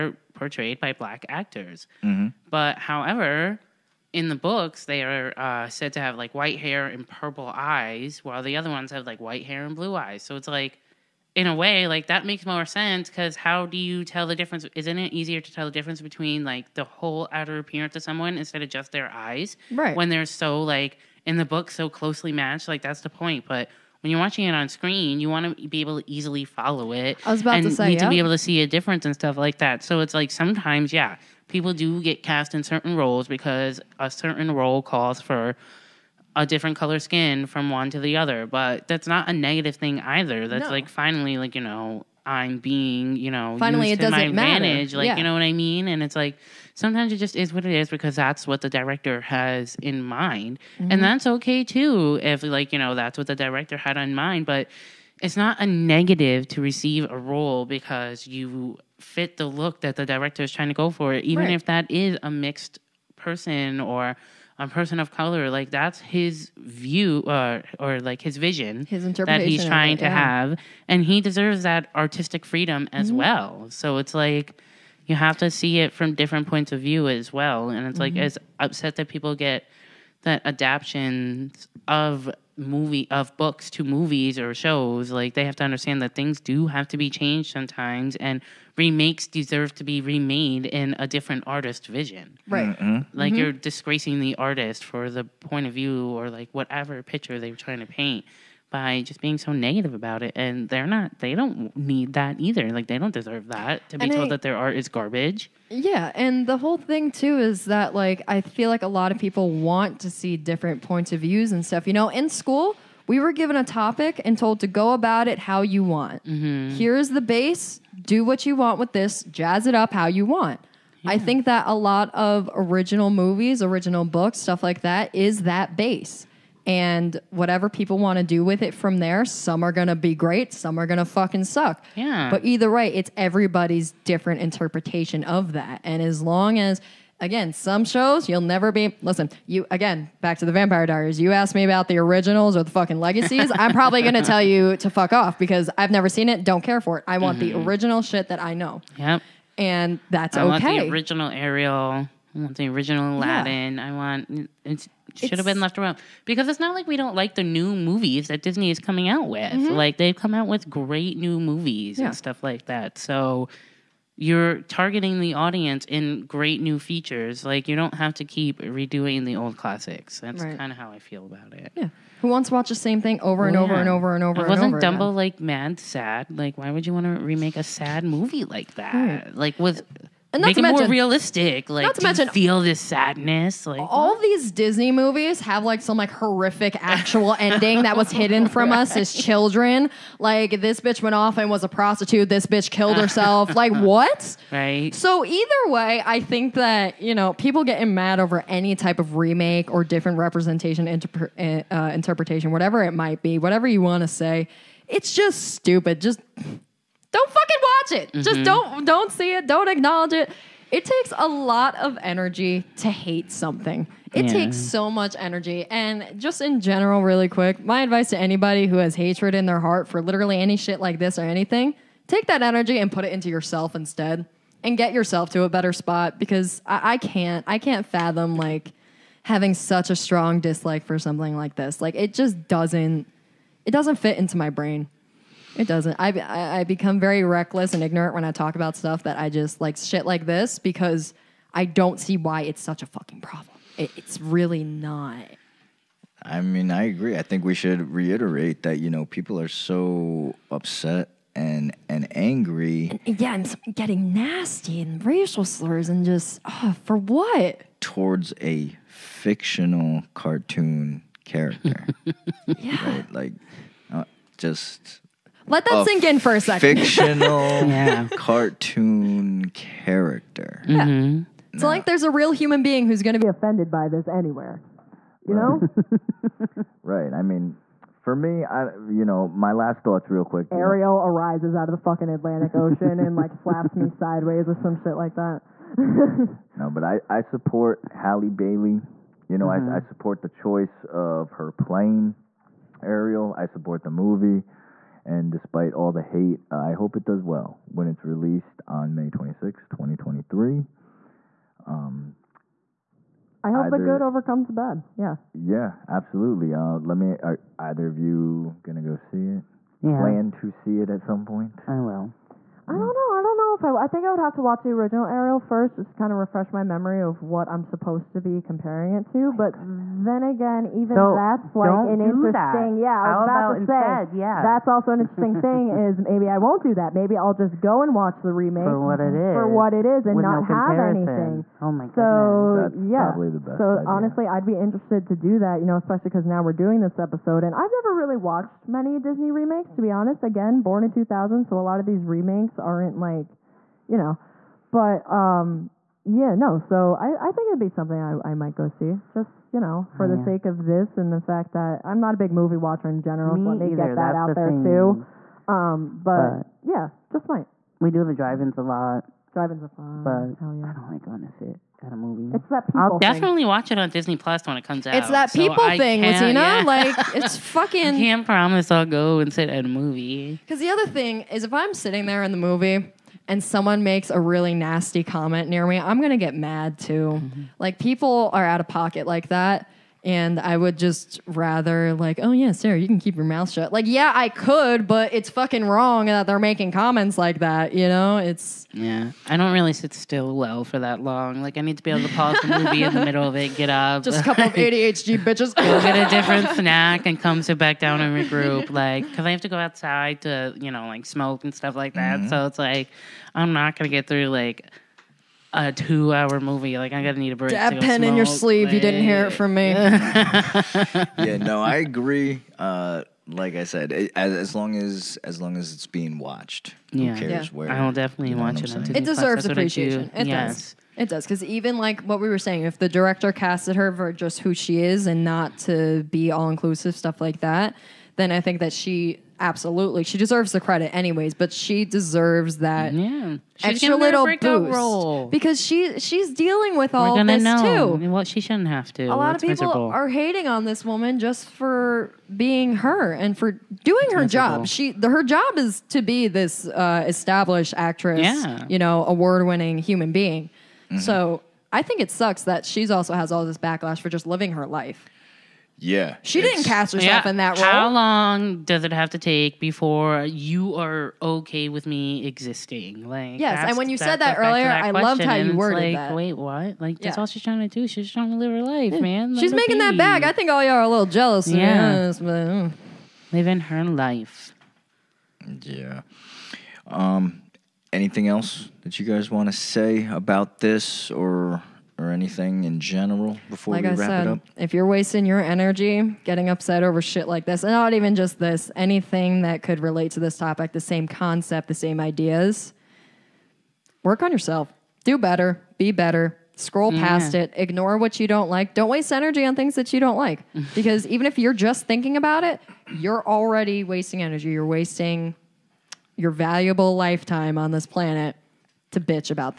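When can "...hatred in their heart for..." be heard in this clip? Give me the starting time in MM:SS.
03:38.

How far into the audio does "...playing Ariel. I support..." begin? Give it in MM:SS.
04:51.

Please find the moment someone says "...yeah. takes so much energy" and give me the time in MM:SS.
03:34.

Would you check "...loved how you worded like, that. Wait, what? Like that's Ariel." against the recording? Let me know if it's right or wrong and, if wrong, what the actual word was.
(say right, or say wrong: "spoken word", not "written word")
wrong: "Yeah", not "Ariel".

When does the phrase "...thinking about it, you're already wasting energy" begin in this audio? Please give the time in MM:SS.
08:21.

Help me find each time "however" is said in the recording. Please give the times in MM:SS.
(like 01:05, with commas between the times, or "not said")
00:02.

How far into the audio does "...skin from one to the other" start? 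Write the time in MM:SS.
00:36.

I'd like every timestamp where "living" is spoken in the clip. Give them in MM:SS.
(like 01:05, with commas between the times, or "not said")
07:34, 07:53.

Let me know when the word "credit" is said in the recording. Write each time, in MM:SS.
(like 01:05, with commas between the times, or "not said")
07:10.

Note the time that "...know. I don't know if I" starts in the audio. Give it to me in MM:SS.
05:12.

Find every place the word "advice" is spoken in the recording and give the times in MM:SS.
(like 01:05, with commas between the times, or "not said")
03:37.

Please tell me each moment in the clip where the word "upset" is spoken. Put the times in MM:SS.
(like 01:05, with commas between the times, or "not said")
01:18, 04:10, 08:06.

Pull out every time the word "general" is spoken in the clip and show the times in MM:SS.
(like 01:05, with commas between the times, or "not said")
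03:36, 05:53, 08:02.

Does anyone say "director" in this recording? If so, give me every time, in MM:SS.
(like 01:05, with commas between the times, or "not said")
00:48, 00:53, 01:00, 07:02.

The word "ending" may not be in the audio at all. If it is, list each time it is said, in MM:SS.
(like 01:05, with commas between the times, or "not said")
03:07.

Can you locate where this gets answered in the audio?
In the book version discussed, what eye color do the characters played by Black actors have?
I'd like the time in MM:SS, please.
00:07.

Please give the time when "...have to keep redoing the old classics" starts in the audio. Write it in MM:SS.
02:47.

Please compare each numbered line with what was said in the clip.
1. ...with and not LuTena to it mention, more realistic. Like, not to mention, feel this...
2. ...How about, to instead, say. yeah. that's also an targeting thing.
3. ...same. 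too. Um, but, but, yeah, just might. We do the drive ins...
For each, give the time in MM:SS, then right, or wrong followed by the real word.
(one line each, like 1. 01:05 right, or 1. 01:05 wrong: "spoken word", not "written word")
1. 02:59 wrong: "Make", not "LuTena"
2. 05:23 wrong: "interesting", not "targeting"
3. 05:54 right.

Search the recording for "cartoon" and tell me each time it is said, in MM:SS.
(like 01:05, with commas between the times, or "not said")
04:20, 04:28.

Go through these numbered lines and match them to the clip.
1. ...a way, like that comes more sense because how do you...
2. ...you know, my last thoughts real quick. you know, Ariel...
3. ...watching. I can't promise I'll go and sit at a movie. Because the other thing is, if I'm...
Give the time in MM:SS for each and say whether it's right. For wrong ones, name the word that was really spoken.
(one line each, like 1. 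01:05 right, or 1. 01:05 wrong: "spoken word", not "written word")
1. 00:11 wrong: "makes", not "comes"
2. 04:38 right
3. 06:07 wrong: "fucking", not "watching".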